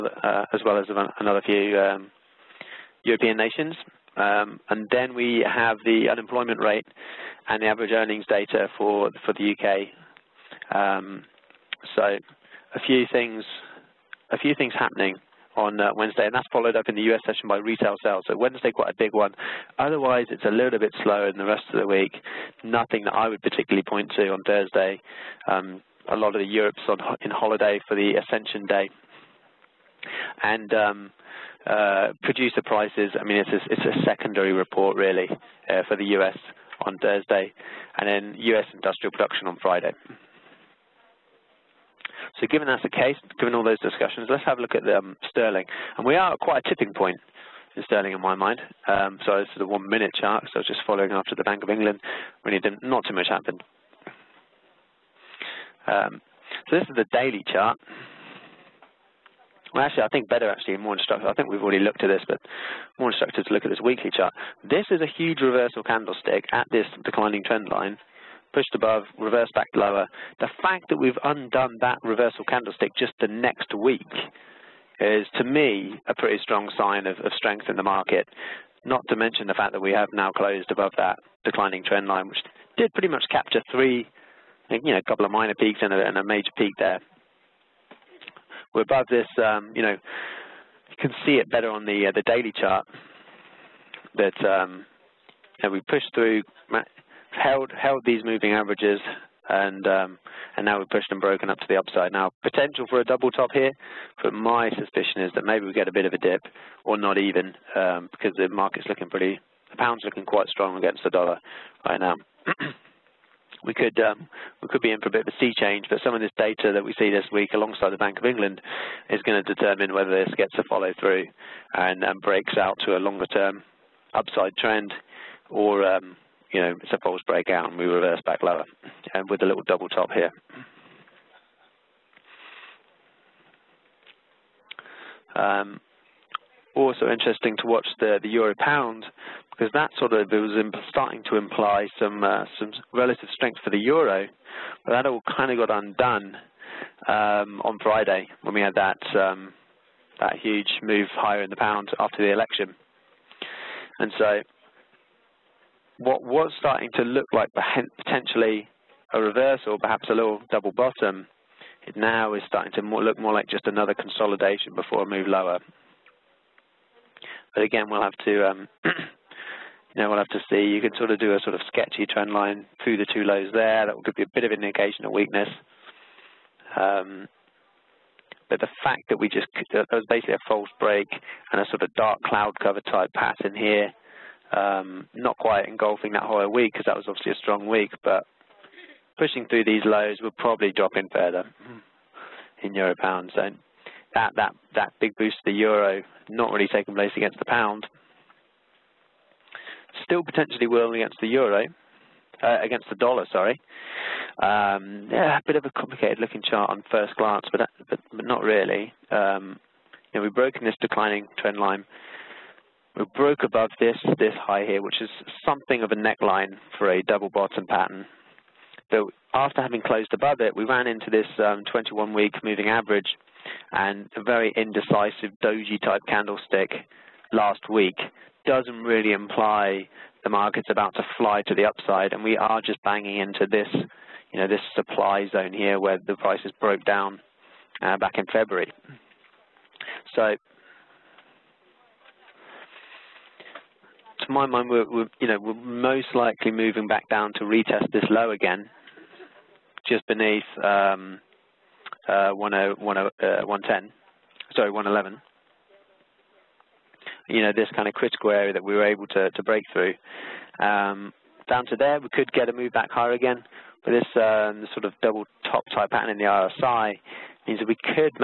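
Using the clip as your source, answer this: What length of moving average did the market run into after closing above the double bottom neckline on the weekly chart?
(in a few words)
21-week.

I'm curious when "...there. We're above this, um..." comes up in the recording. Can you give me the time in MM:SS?
01:26.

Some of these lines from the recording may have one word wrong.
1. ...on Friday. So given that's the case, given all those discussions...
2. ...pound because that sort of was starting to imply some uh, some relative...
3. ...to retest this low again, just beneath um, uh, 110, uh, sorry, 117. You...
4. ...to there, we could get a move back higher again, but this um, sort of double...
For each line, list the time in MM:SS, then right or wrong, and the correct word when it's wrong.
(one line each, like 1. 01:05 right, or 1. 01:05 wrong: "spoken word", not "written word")
1. 00:39 right
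2. 02:18 right
3. 04:07 wrong: "111", not "117"
4. 04:21 right.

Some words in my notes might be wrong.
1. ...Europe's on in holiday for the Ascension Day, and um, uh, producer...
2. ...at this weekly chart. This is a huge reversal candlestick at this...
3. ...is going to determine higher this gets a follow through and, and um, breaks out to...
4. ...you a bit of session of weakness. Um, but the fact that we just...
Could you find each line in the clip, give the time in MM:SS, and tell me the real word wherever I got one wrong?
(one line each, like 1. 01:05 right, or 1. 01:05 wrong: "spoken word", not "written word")
1. 00:26 right
2. 01:03 right
3. 01:59 wrong: "whether", not "higher"
4. 02:54 wrong: "indication", not "session".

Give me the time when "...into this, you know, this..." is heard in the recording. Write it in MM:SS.
03:53.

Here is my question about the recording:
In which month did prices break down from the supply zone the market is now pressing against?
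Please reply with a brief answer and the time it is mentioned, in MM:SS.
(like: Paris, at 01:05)
February, at 03:58.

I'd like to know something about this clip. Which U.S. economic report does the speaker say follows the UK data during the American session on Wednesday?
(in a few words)
Retail sales.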